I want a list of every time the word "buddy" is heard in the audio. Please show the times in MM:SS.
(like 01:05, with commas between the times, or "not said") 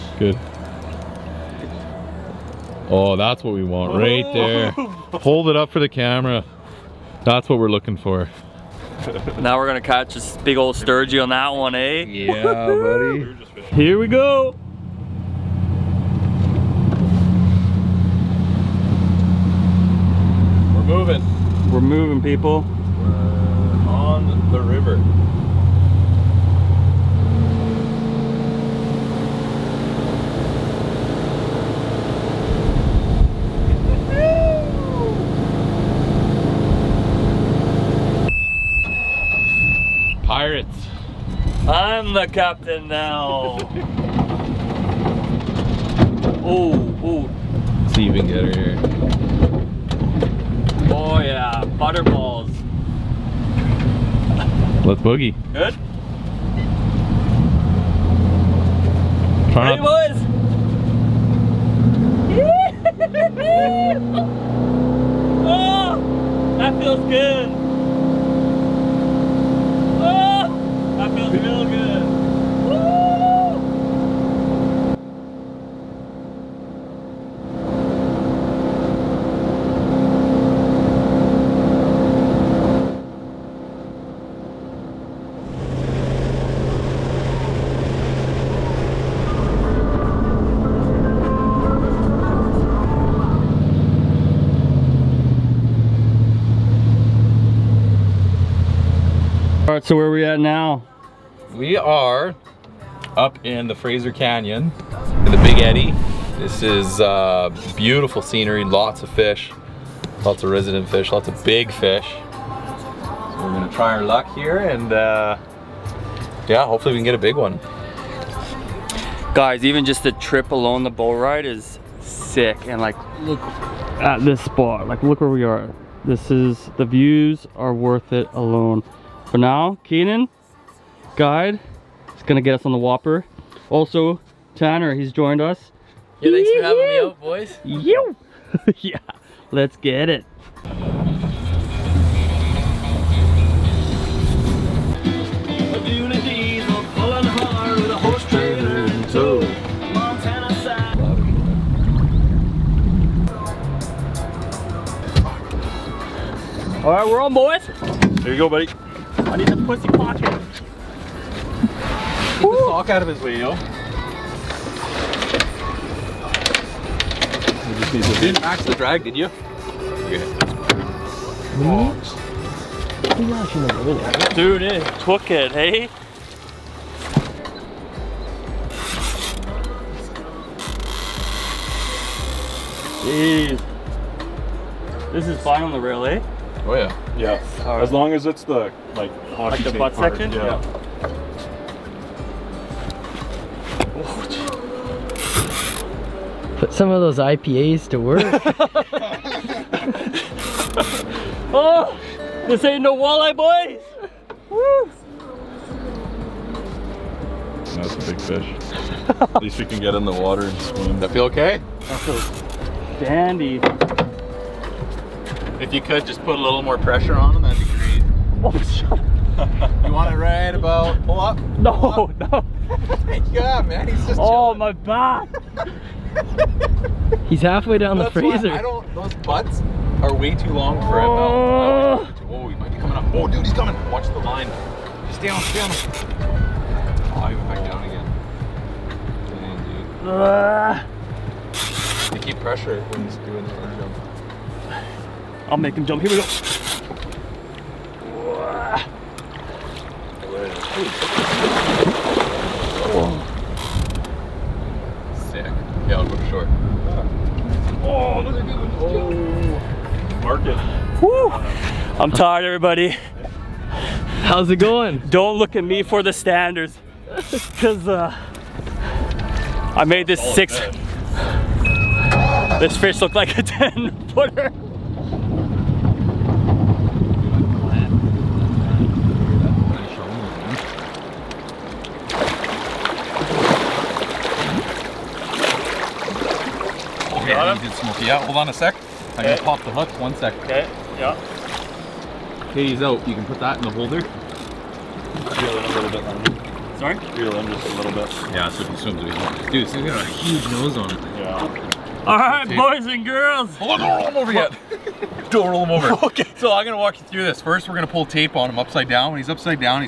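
00:12, 02:38.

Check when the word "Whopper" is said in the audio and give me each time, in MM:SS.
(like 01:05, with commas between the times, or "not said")
02:12.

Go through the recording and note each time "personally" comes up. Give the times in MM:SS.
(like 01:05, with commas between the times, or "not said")
not said.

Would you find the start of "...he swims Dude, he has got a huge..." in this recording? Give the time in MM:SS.
04:58.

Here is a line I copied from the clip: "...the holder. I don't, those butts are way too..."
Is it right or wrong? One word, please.
wrong.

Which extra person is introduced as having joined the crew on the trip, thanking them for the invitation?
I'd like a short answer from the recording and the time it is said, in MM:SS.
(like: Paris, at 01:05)
Tanner, at 02:14.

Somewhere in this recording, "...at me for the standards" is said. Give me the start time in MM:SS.
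04:25.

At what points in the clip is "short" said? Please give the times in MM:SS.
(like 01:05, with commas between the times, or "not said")
04:16.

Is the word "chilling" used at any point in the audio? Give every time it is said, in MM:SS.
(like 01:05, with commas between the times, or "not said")
03:44.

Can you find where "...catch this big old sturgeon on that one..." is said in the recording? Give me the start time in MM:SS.
00:09.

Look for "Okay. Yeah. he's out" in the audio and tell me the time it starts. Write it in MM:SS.
04:50.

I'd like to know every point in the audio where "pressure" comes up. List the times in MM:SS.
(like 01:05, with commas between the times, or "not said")
03:36, 04:02.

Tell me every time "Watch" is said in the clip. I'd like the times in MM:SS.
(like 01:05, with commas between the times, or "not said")
03:53.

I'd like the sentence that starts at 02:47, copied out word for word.
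You didn't max the drag, did you?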